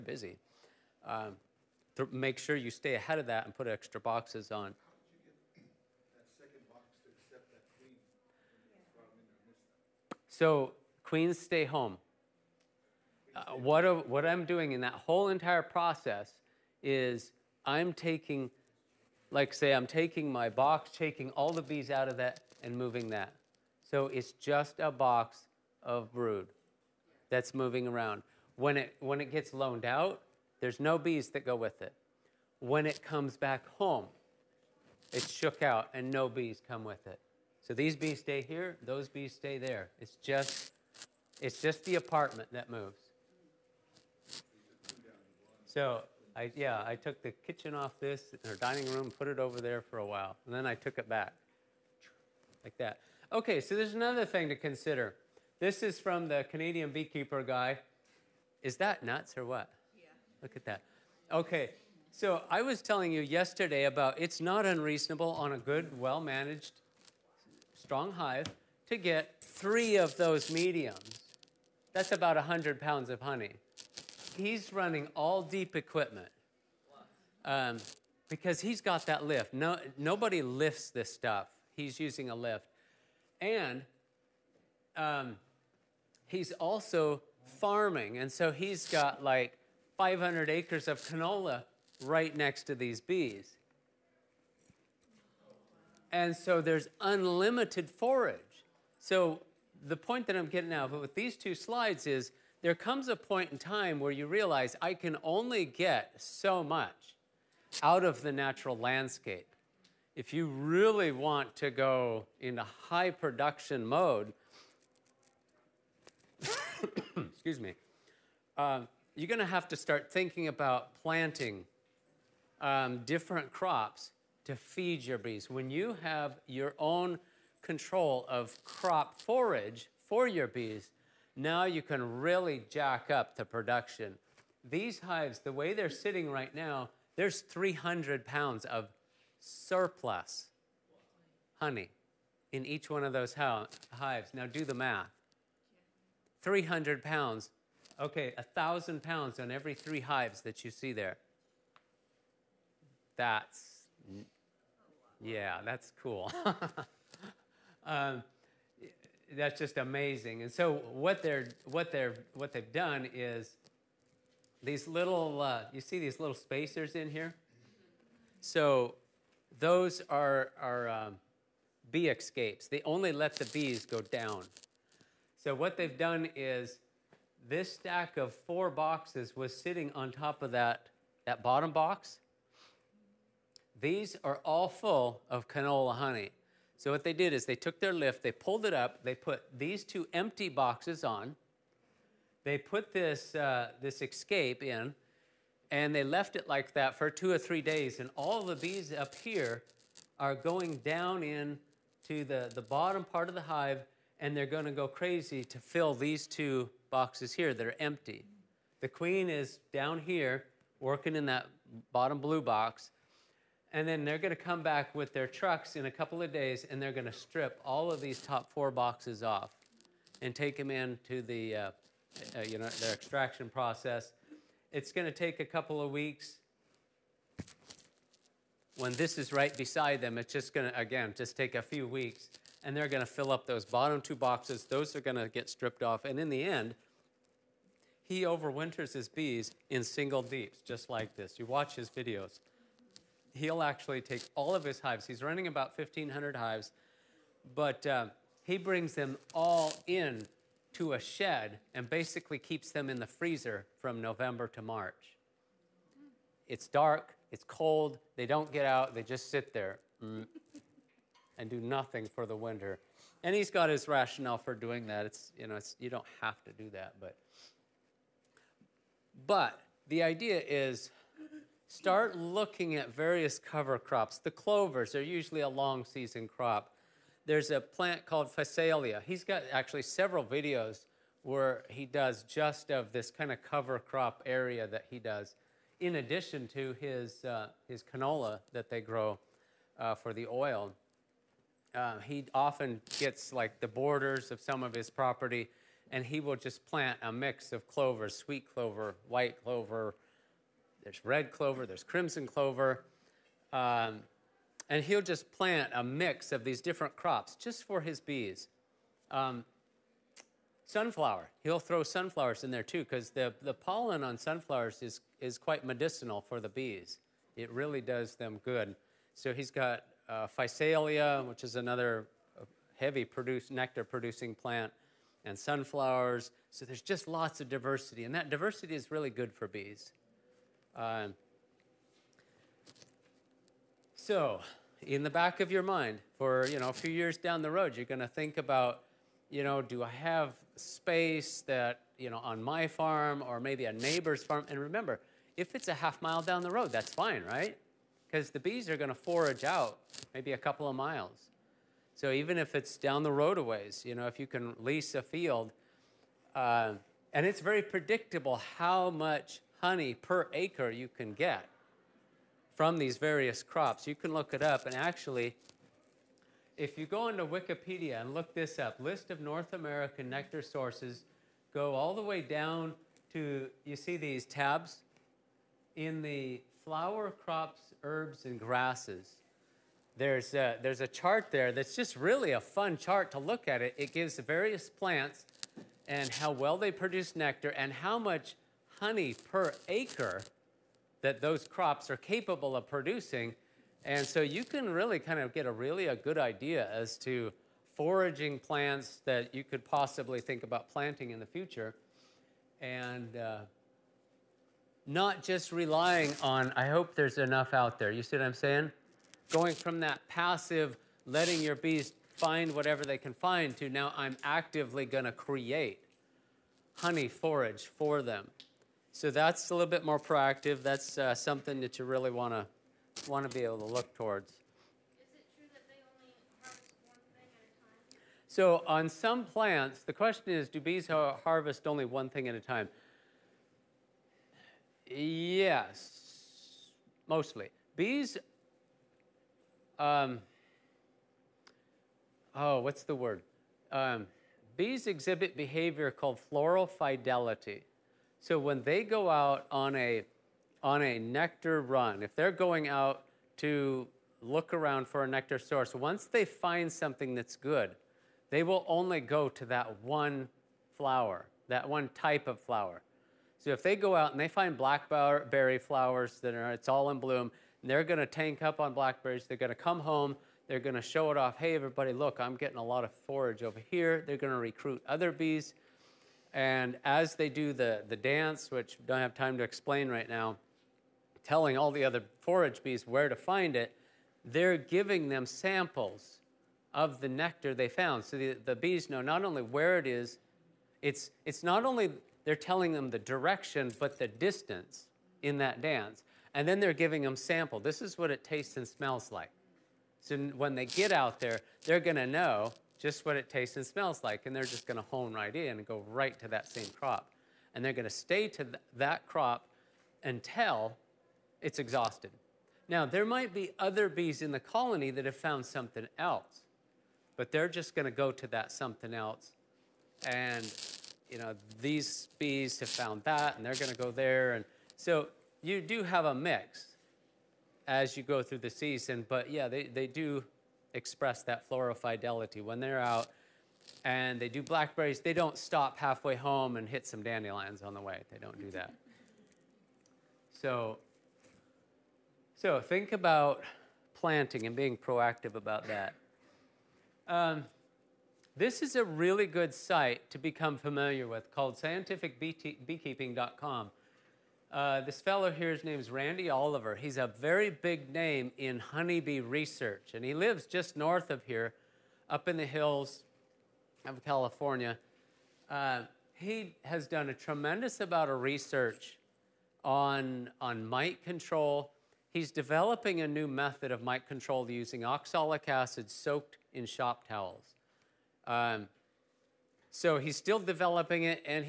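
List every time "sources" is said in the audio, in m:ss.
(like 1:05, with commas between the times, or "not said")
6:10, 7:35.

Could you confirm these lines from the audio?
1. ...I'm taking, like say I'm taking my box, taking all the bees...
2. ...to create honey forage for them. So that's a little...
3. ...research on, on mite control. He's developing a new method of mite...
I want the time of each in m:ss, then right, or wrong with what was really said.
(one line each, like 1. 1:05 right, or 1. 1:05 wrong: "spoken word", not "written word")
1. 0:17 right
2. 6:55 right
3. 9:28 right.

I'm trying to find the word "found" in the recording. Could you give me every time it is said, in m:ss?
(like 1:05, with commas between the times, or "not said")
8:07, 8:35, 8:42.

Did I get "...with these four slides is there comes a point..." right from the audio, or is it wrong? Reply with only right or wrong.
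wrong.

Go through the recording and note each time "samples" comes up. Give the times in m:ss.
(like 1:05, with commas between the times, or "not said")
8:05, 8:17.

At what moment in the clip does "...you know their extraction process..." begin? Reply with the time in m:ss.
3:42.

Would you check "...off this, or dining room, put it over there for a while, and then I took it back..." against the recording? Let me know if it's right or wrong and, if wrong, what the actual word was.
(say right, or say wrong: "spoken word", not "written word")
right.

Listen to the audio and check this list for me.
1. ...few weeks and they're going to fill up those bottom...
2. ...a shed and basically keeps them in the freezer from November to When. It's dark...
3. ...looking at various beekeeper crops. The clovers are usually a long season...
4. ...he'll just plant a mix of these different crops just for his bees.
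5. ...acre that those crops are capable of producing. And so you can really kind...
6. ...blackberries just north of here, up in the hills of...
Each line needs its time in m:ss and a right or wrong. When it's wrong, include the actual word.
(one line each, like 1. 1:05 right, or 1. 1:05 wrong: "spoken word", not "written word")
1. 3:51 right
2. 4:10 wrong: "March", not "When"
3. 4:32 wrong: "cover", not "beekeeper"
4. 5:04 right
5. 6:29 right
6. 9:20 wrong: "lives", not "blackberries".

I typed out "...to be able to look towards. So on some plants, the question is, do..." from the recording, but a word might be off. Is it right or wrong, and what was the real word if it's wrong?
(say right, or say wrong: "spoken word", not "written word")
right.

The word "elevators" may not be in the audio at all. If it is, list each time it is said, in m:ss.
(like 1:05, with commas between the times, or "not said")
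not said.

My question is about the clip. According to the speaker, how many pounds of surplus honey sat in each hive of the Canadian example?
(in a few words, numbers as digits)
300.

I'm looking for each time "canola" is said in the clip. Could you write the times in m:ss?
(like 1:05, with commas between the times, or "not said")
1:31, 3:05, 4:47.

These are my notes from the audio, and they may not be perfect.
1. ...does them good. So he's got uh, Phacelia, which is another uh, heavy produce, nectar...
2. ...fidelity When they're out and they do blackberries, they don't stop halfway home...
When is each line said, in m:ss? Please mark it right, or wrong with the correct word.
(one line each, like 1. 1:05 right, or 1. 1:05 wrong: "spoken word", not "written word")
1. 5:17 right
2. 8:51 right.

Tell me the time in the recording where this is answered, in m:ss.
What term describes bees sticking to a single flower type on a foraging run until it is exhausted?
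7:26.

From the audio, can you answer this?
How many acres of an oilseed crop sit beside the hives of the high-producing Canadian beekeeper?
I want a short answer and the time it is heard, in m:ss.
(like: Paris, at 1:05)
500, at 1:29.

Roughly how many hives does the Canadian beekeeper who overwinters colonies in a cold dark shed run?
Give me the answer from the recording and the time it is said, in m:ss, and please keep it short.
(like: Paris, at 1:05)
About 1,500, at 4:05.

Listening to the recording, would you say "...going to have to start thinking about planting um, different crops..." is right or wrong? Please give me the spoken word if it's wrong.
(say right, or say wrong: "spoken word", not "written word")
right.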